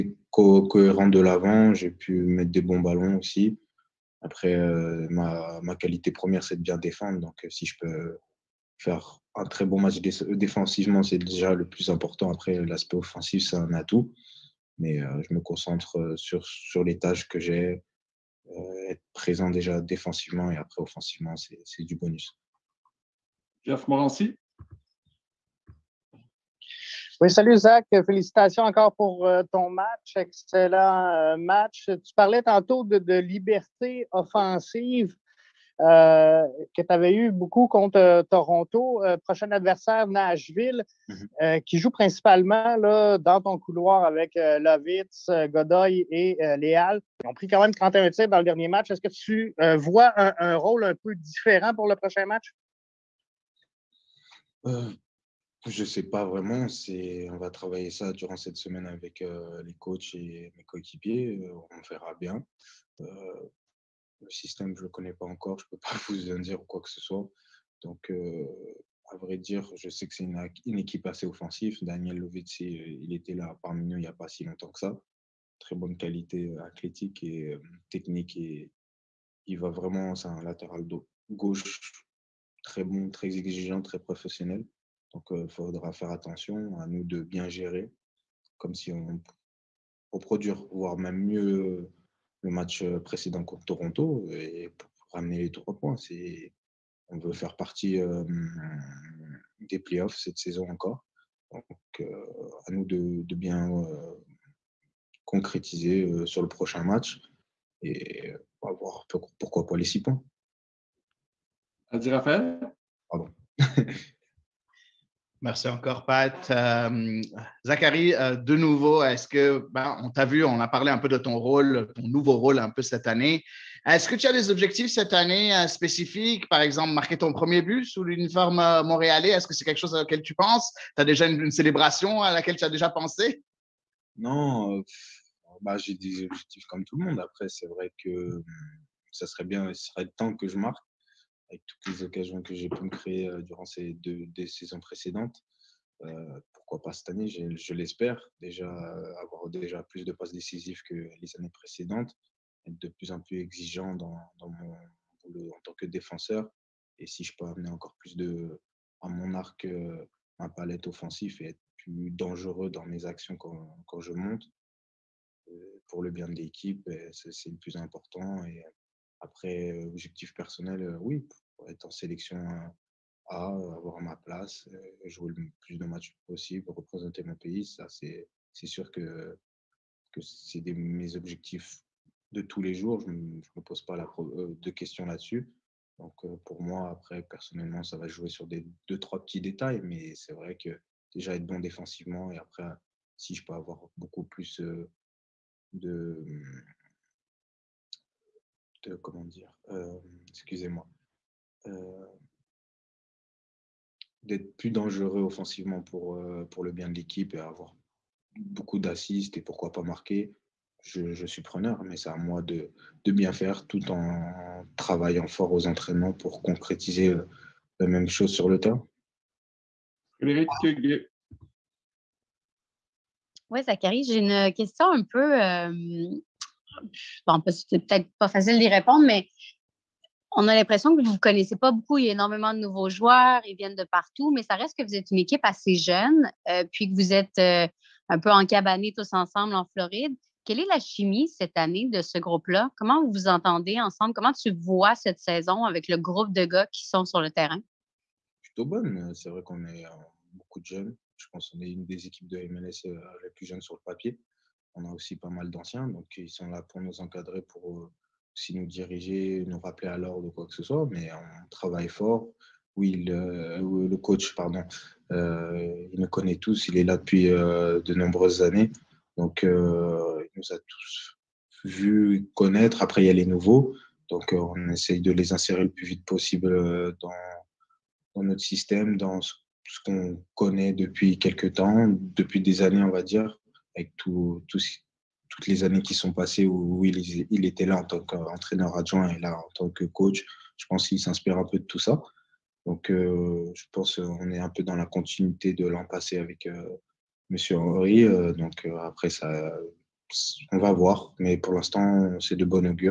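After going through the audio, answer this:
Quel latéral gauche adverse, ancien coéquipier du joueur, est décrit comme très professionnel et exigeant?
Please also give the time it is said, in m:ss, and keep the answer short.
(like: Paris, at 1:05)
Daniel Lovitz, at 1:11.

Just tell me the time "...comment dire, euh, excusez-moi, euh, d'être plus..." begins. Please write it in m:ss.
3:19.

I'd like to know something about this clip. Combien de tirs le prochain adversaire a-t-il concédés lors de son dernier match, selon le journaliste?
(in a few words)
31.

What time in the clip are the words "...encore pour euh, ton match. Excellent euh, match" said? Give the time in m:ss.
0:28.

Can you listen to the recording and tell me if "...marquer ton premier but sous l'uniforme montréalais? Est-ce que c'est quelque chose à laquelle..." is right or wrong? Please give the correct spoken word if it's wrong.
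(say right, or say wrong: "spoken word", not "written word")
right.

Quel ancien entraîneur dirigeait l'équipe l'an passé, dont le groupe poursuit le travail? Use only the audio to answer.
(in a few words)
Henry.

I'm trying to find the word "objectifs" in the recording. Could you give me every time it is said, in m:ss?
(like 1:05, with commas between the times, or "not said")
2:04, 2:16, 2:49, 3:01.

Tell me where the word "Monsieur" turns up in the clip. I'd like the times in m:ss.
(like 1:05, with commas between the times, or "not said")
4:57.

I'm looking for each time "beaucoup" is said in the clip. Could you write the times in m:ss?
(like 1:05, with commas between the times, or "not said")
0:37, 3:13, 3:28, 3:51, 4:10.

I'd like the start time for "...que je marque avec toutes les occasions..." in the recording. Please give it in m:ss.
2:20.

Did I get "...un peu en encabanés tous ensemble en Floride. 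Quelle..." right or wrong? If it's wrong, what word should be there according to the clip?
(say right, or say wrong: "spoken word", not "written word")
right.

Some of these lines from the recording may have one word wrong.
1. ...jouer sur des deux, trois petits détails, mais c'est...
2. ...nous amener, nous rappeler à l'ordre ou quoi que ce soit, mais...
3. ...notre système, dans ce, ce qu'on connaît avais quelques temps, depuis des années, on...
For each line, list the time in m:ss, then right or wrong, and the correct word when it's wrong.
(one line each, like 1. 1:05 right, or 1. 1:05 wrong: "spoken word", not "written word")
1. 3:08 right
2. 4:18 wrong: "diriger", not "amener"
3. 4:38 wrong: "depuis", not "avais".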